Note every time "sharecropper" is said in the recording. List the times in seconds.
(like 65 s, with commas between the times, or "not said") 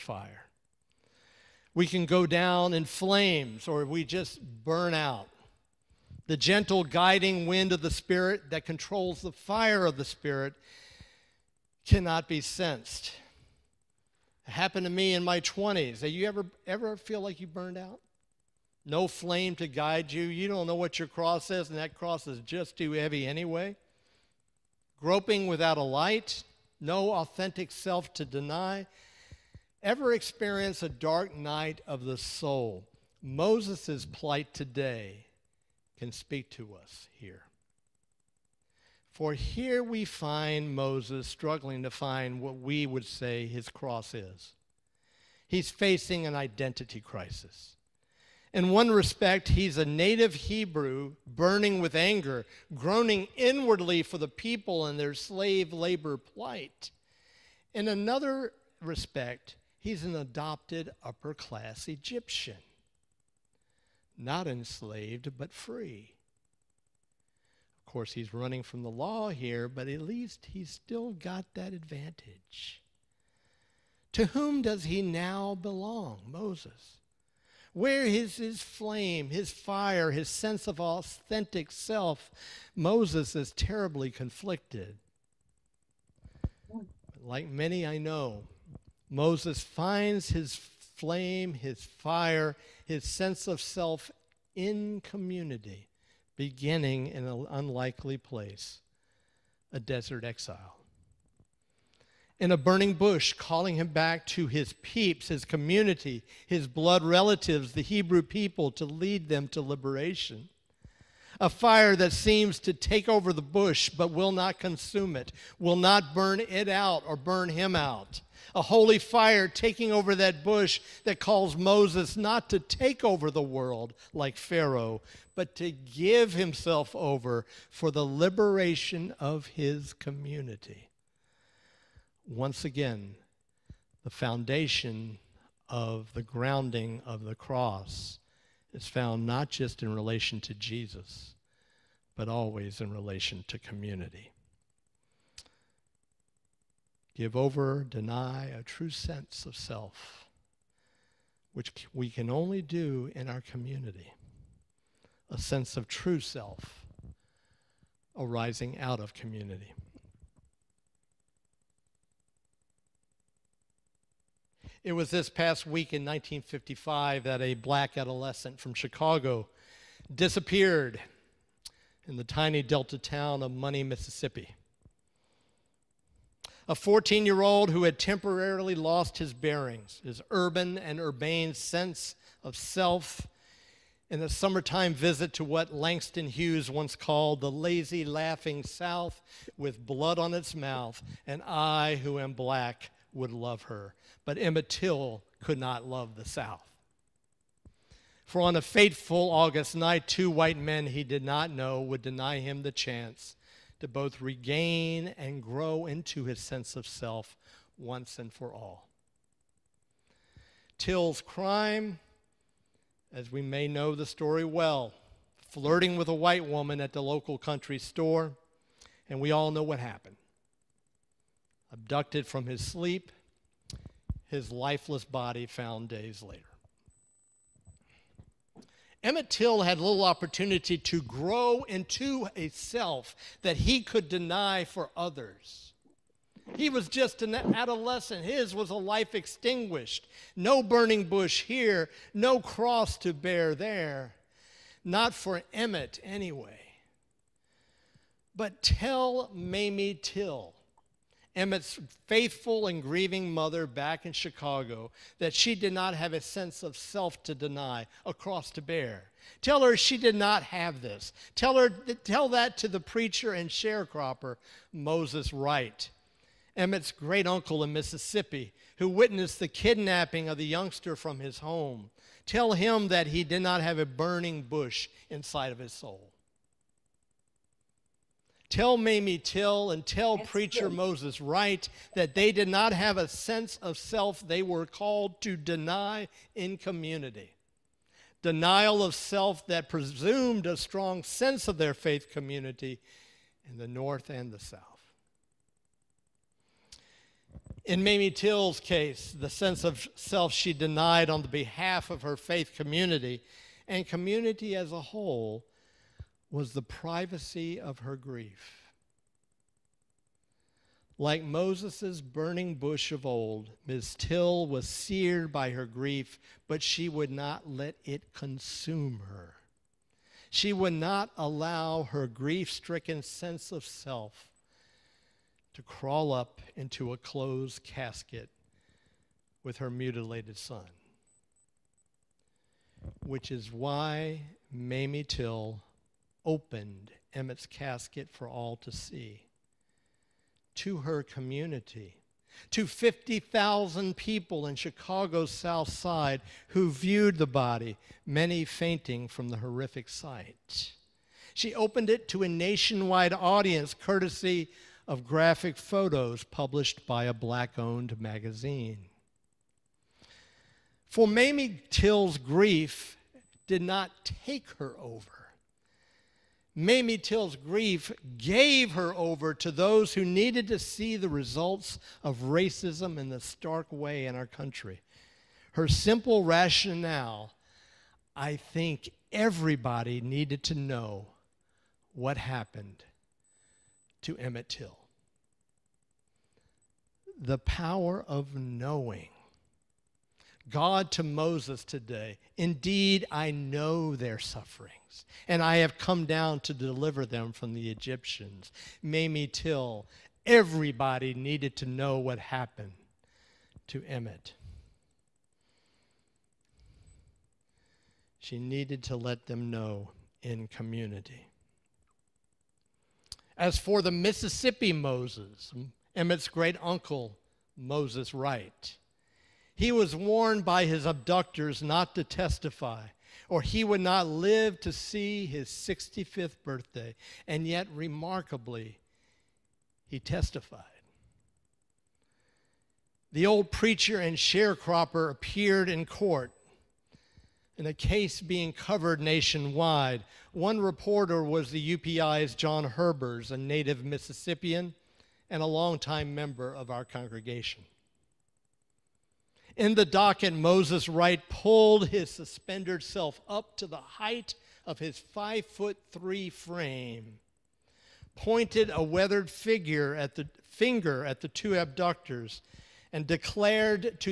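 263 s, 434 s.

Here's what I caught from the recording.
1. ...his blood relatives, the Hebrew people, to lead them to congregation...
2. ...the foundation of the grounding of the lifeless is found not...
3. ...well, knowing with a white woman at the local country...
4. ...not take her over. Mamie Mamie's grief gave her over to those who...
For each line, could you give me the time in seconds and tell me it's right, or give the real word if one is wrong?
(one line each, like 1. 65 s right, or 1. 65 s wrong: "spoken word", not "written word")
1. 106 s wrong: "liberation", not "congregation"
2. 134 s wrong: "cross", not "lifeless"
3. 214 s wrong: "flirting", not "knowing"
4. 363 s wrong: "Till", not "Mamie".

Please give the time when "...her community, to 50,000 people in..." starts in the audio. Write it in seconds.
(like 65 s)
340 s.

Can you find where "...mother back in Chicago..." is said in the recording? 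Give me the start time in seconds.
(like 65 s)
253 s.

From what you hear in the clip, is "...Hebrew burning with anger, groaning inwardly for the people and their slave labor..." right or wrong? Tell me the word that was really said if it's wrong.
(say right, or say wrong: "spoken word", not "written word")
right.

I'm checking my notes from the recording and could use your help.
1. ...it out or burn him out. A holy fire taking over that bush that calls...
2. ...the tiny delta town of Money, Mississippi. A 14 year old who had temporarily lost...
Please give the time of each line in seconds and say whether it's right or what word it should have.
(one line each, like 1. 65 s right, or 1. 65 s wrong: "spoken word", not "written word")
1. 116 s right
2. 172 s right.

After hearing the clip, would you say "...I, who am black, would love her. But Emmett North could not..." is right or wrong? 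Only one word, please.
wrong.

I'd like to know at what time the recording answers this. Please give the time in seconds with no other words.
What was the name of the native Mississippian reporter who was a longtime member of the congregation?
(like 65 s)
442 s.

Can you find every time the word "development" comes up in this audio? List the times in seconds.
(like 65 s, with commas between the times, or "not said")
not said.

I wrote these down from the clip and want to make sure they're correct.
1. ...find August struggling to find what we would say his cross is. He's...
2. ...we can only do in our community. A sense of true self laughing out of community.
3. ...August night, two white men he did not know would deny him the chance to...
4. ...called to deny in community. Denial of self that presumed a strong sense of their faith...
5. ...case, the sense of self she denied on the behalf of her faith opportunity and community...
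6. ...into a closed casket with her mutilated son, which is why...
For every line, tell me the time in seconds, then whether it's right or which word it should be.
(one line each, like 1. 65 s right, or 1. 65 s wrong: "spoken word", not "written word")
1. 40 s wrong: "Moses", not "August"
2. 151 s wrong: "arising", not "laughing"
3. 199 s right
4. 284 s right
5. 298 s wrong: "community", not "opportunity"
6. 326 s right.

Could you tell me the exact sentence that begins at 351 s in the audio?
She opened it to a nationwide audience courtesy of graphic photos published by a black owned magazine.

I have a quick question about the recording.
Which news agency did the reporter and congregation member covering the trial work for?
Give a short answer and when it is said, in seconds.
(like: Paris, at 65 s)
UPI, at 441 s.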